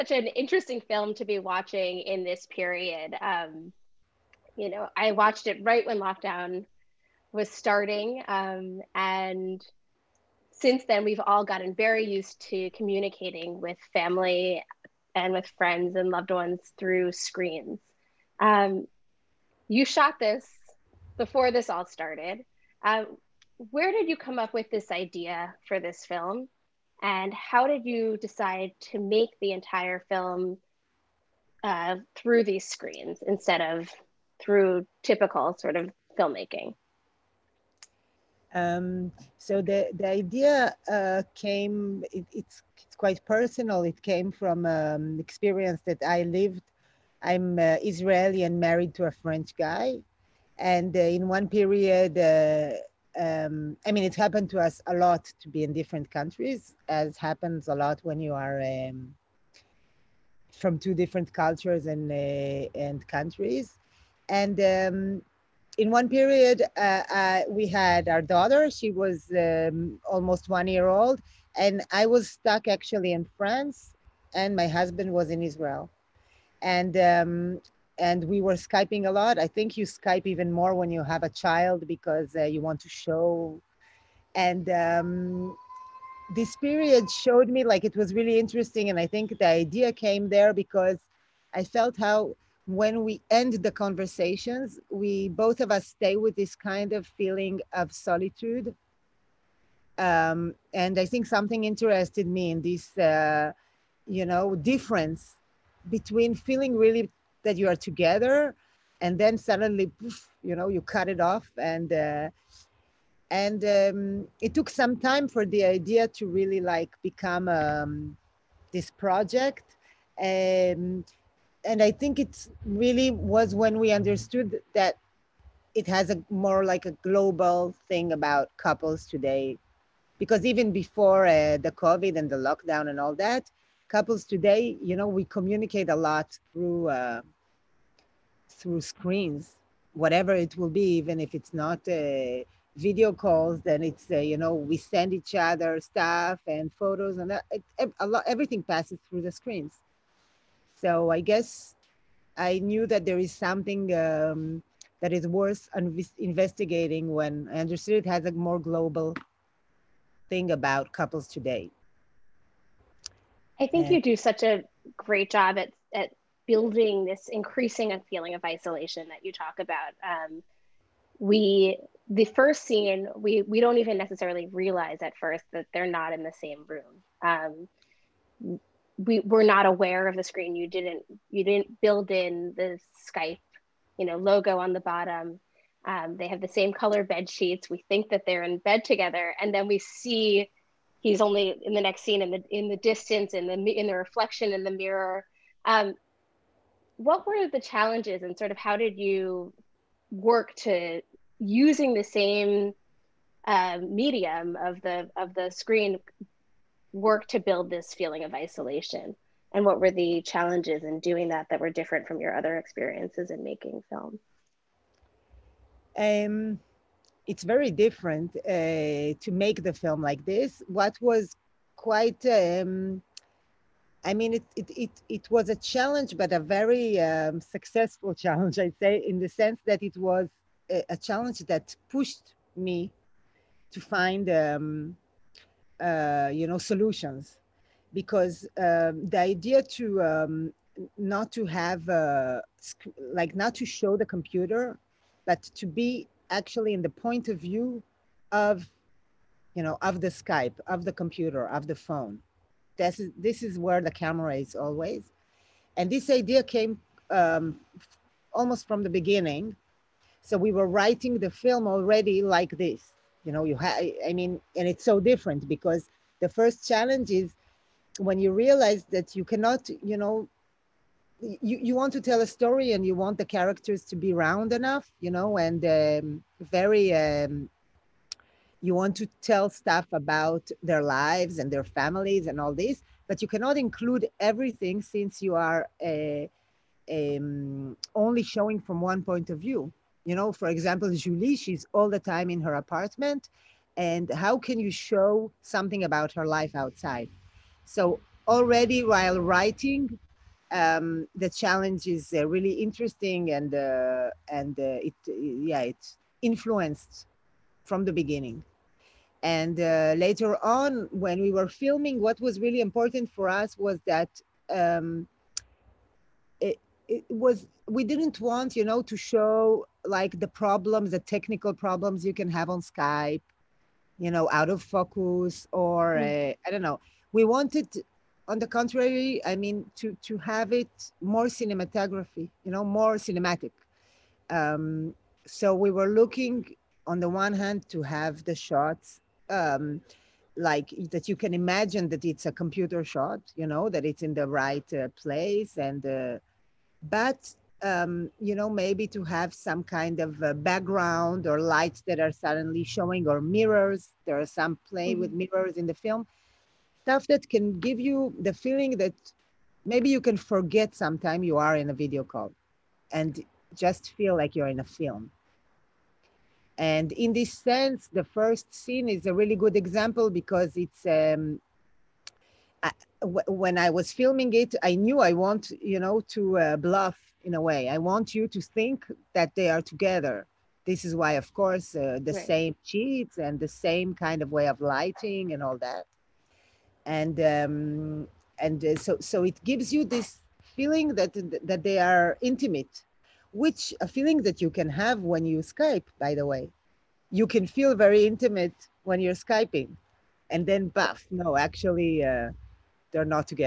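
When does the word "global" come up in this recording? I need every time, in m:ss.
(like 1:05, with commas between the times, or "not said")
2:07, 2:38.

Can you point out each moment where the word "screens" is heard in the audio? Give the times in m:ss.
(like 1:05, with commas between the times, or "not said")
0:17, 0:32, 2:18, 2:29, 3:00, 3:25.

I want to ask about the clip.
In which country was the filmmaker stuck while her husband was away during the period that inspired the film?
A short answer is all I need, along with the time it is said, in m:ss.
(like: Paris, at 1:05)
France, at 1:13.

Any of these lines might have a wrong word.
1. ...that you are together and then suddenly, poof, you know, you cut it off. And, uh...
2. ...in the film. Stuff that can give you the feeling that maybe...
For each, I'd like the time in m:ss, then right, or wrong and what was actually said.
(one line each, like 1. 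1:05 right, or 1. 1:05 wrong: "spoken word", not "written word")
1. 1:47 right
2. 5:55 right.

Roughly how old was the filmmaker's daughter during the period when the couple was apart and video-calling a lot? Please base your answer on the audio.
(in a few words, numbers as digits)
almost one year.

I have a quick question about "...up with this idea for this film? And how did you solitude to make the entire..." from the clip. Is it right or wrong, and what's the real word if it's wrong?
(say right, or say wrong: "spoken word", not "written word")
wrong: "decide", not "solitude".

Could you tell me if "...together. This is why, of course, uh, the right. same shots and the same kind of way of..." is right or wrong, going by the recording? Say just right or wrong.
wrong.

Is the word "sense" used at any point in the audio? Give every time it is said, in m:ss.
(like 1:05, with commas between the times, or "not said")
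3:49, 6:07.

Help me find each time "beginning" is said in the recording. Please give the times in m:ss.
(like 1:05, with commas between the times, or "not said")
4:18, 5:07.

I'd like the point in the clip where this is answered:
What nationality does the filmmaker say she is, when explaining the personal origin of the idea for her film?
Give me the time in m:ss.
0:47.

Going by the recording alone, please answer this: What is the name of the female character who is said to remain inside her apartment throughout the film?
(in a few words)
Julie.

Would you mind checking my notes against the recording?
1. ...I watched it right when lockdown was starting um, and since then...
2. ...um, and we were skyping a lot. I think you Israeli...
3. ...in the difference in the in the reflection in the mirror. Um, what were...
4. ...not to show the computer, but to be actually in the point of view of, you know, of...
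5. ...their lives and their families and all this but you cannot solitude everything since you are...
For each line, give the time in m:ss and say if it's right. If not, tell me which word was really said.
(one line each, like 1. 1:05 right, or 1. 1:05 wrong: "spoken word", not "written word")
1. 0:04 right
2. 1:16 wrong: "Skype", not "Israeli"
3. 3:12 wrong: "distance", not "difference"
4. 4:03 right
5. 4:40 wrong: "include", not "solitude".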